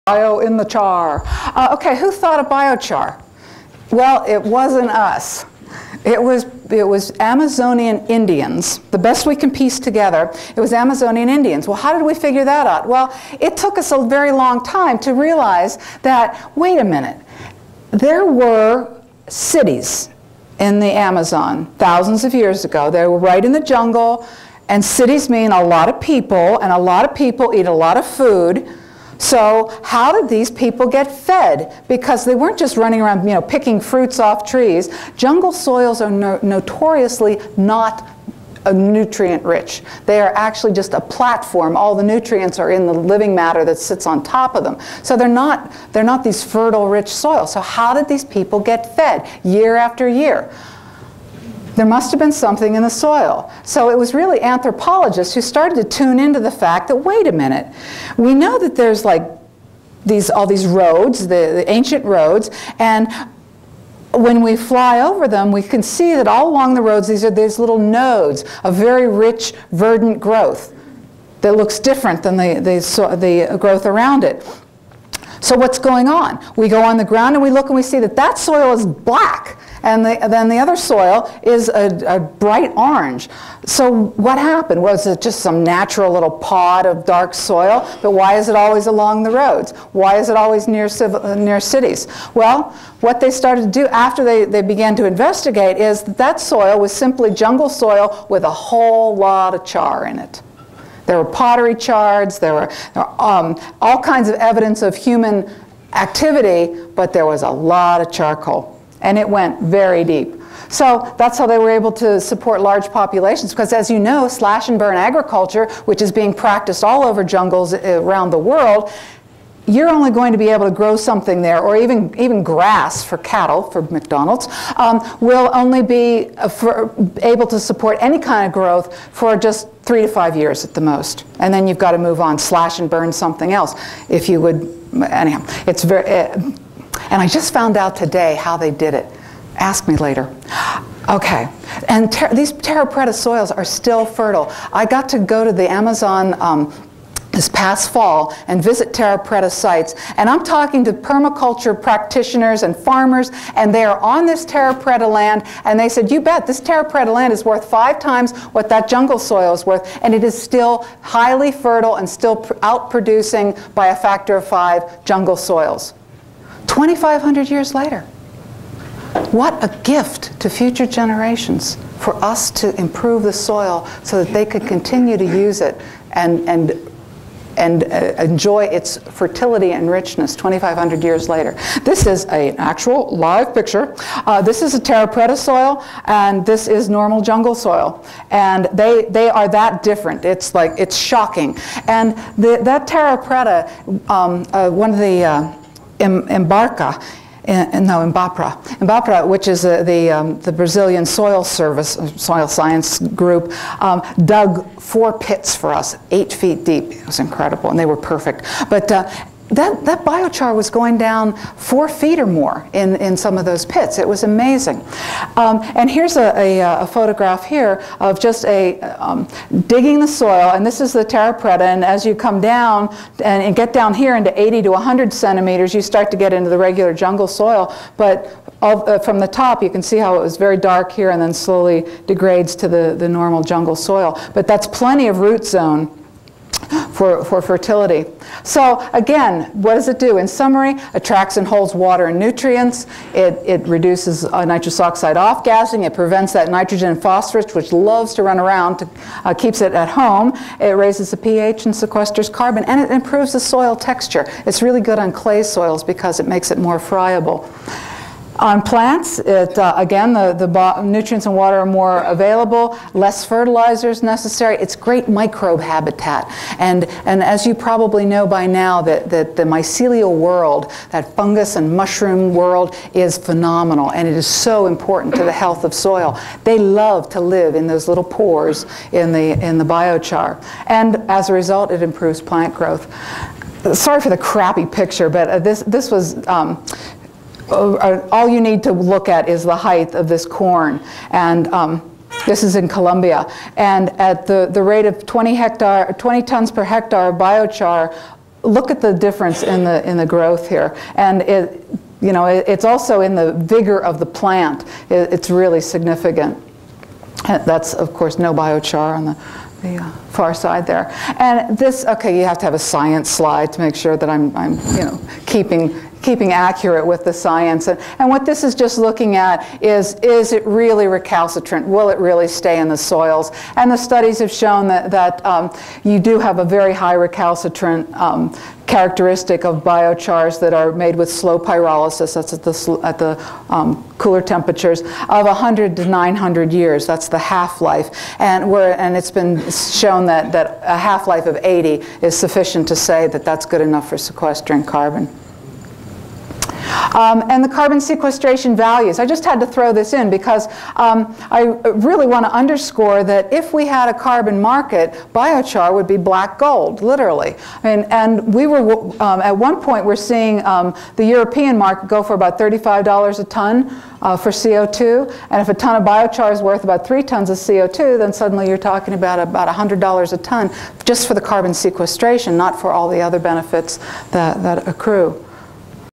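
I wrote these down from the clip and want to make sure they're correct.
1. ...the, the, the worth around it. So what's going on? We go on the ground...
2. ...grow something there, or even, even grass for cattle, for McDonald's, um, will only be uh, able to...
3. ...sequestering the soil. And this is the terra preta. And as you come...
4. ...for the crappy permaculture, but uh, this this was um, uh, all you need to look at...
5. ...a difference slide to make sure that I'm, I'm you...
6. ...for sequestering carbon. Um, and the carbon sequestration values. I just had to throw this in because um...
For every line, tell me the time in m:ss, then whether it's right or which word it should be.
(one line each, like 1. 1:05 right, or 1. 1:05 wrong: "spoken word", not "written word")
1. 1:12 wrong: "growth", not "worth"
2. 2:00 right
3. 3:39 wrong: "digging", not "sequestering"
4. 4:44 wrong: "picture", not "permaculture"
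5. 5:12 wrong: "science", not "difference"
6. 5:43 right.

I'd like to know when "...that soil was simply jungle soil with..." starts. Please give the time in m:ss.
1:36.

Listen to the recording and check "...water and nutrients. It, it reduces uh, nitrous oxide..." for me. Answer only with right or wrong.
right.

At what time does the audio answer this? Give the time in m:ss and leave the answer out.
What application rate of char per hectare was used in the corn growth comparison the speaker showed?
4:55.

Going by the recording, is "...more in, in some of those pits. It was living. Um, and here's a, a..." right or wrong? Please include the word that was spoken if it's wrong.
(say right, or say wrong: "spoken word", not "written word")
wrong: "amazing", not "living".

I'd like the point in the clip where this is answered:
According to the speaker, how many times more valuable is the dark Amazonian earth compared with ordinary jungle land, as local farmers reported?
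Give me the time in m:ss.
2:37.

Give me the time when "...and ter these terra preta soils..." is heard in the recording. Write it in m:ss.
2:21.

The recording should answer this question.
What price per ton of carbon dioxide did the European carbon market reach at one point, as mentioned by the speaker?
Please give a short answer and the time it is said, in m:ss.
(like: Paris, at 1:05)
$35, at 6:02.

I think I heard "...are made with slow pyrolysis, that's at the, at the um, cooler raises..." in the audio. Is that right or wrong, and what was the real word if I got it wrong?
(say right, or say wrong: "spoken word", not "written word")
wrong: "temperatures", not "raises".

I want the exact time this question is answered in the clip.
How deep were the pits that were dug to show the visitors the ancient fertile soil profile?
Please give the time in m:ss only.
3:26.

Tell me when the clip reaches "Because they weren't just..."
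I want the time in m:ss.
0:31.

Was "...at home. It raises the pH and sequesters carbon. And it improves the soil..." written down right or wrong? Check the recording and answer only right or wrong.
right.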